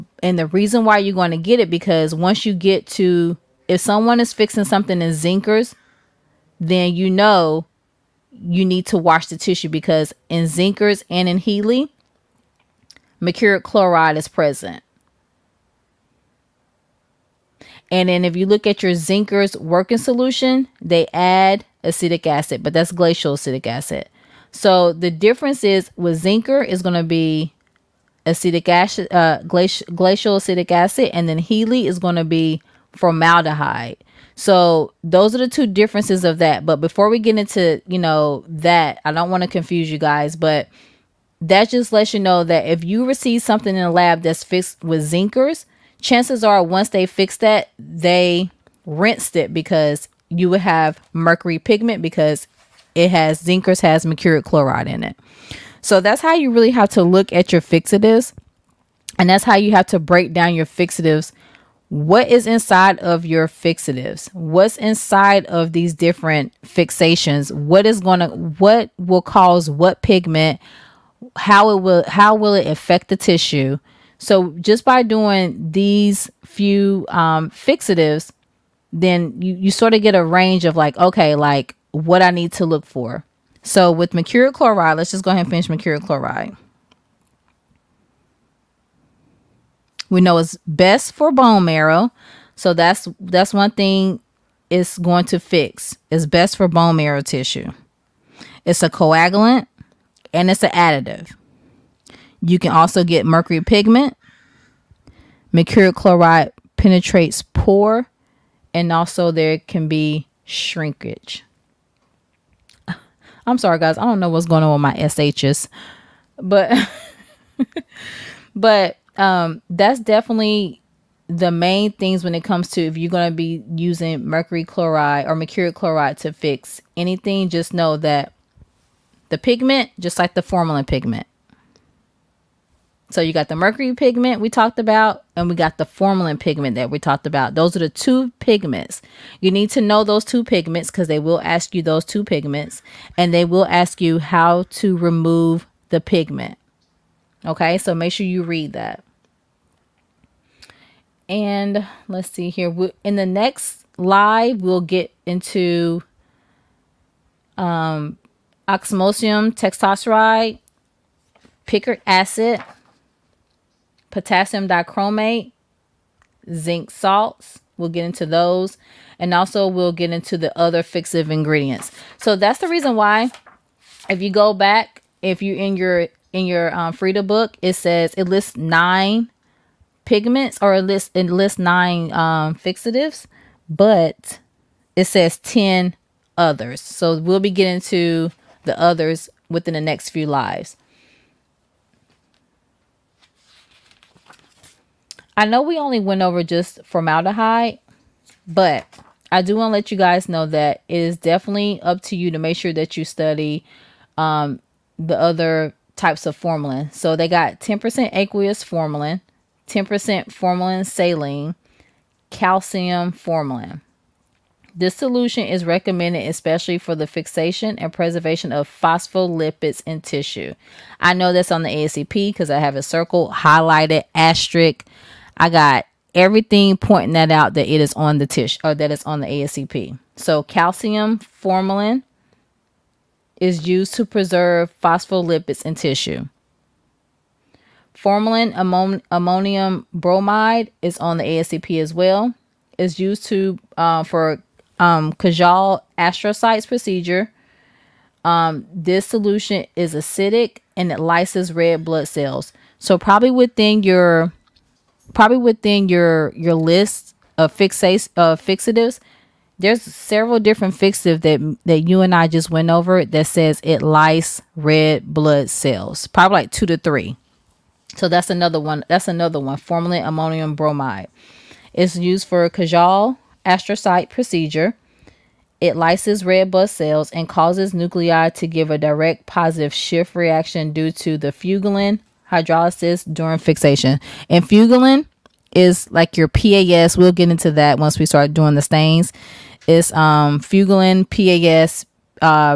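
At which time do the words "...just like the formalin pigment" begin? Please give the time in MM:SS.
02:09.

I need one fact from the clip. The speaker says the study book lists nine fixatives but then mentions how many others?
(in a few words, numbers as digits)
10.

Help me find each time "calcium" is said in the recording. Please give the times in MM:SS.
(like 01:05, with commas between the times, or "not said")
03:32, 03:50.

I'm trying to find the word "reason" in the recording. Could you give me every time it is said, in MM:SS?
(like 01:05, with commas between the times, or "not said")
00:00, 02:52.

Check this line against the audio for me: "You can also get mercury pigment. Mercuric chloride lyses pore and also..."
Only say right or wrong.
wrong.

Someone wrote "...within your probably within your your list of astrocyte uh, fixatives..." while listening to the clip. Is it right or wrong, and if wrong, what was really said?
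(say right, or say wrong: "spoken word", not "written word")
wrong: "fixate", not "astrocyte".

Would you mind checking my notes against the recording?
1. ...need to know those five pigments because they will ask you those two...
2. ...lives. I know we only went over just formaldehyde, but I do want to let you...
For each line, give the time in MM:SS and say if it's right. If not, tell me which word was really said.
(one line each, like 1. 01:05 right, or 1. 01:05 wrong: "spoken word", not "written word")
1. 02:19 wrong: "two", not "five"
2. 03:10 right.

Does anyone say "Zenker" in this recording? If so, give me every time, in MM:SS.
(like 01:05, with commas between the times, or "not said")
00:05, 00:10, 00:18, 00:26, 00:45, 00:53.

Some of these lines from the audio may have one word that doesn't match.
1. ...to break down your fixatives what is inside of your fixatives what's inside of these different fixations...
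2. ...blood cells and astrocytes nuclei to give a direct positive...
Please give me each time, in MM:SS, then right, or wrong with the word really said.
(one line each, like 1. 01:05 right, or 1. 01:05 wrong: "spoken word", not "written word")
1. 00:59 right
2. 04:36 wrong: "causes", not "astrocytes".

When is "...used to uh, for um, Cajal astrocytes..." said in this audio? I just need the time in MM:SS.
04:02.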